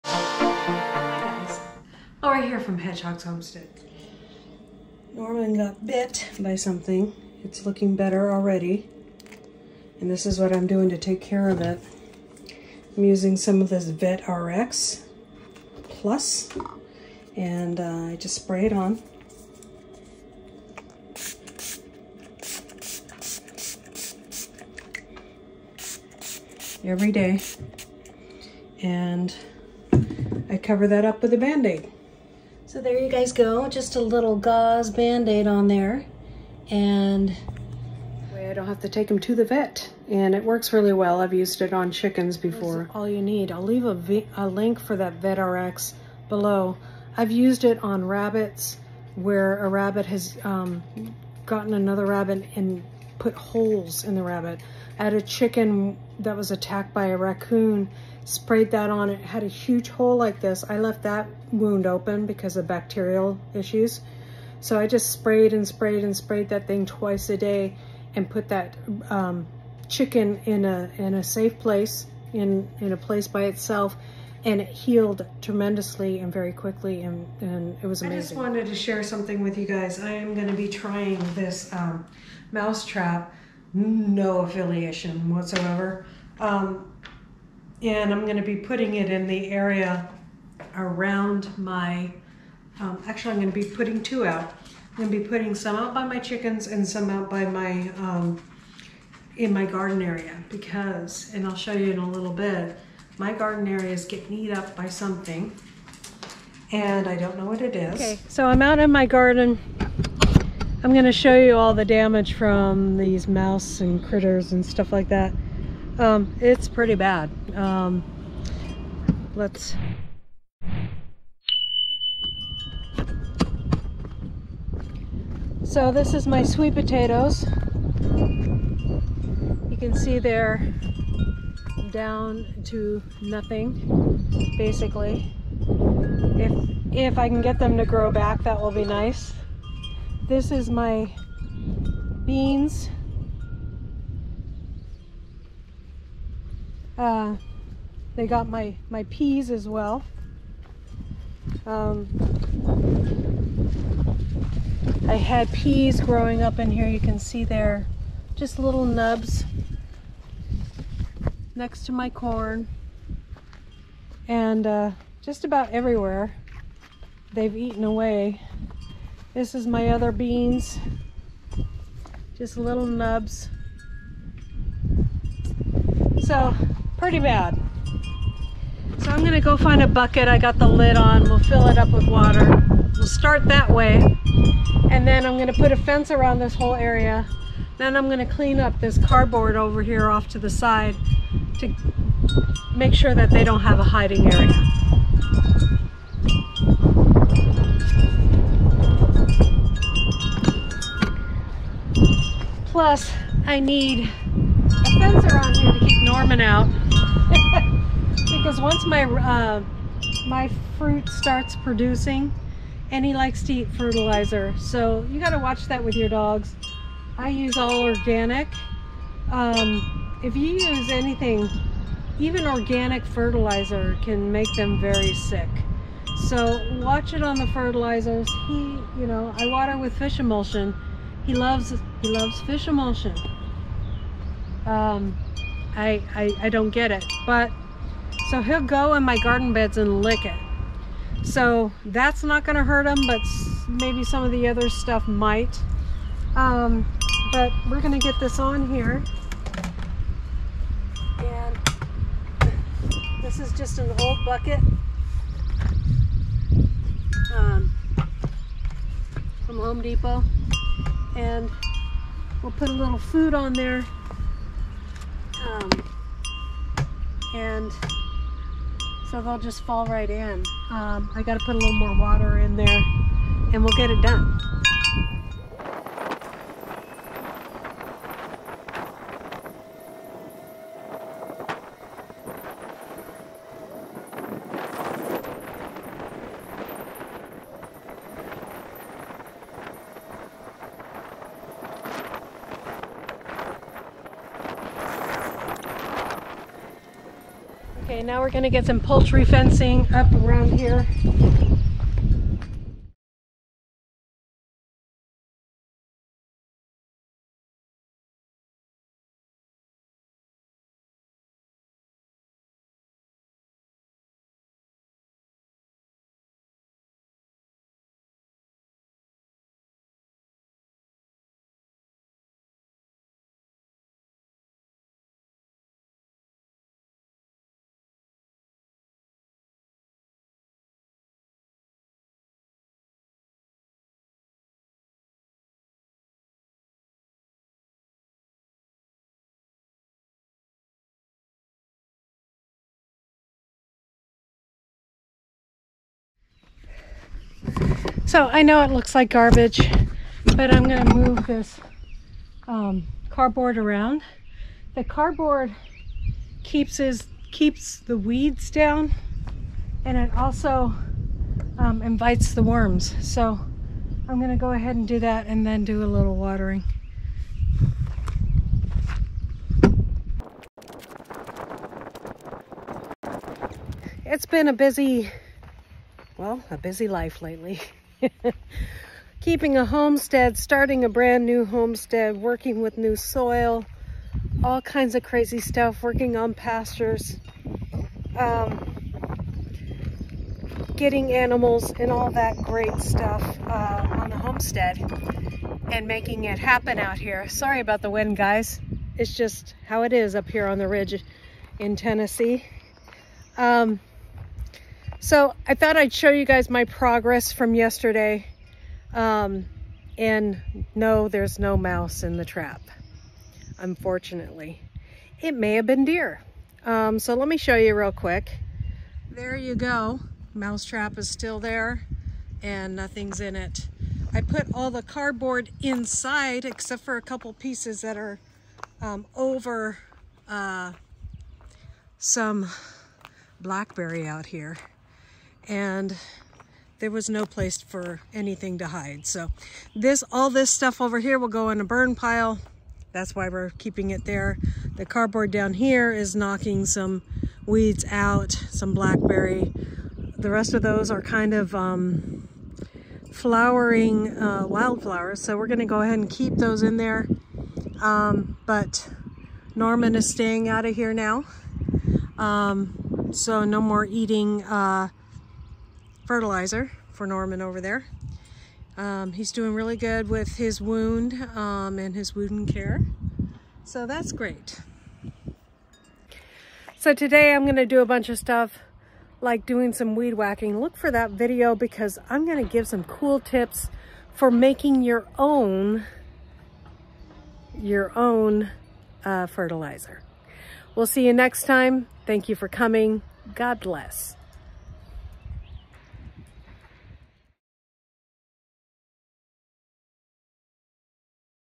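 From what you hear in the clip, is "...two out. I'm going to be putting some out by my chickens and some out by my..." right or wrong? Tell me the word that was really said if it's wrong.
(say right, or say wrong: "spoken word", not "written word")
right.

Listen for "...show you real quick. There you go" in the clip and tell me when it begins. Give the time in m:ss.
6:57.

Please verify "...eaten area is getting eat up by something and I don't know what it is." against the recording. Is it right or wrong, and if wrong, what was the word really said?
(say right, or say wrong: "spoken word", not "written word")
wrong: "garden", not "eaten".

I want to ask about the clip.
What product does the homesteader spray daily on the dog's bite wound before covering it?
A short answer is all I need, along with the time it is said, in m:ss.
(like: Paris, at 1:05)
Vet RX Plus, at 0:13.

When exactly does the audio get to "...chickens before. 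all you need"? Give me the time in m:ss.
0:41.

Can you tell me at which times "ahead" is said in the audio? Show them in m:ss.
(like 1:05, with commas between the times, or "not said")
6:04, 7:35.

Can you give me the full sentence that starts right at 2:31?
Um, I had peas growing up in here.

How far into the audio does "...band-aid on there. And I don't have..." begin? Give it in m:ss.
0:34.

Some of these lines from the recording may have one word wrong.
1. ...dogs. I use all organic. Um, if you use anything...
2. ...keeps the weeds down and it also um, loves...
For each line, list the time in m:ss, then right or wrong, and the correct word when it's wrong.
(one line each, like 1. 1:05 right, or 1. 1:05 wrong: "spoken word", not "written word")
1. 3:36 right
2. 5:57 wrong: "invites", not "loves".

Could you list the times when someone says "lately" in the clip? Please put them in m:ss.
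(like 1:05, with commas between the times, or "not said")
6:17.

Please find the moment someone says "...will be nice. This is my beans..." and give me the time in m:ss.
2:18.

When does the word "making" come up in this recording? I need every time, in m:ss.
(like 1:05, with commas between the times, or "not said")
6:35, 8:04.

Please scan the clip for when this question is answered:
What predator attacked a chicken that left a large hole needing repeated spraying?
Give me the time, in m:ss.
0:57.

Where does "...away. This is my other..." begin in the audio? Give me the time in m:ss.
2:47.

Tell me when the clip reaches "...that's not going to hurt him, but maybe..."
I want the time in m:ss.
4:01.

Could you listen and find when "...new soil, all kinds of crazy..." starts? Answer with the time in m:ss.
6:22.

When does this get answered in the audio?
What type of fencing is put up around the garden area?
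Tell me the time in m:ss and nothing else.
4:58.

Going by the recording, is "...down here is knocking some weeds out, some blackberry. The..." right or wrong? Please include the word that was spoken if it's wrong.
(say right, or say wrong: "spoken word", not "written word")
right.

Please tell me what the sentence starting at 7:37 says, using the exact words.
Um, but Norman is staying out of here now.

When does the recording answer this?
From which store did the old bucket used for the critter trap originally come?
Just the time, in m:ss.
4:19.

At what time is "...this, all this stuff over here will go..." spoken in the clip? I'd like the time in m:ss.
7:19.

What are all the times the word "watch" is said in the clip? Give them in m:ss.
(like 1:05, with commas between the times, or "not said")
3:35, 3:46.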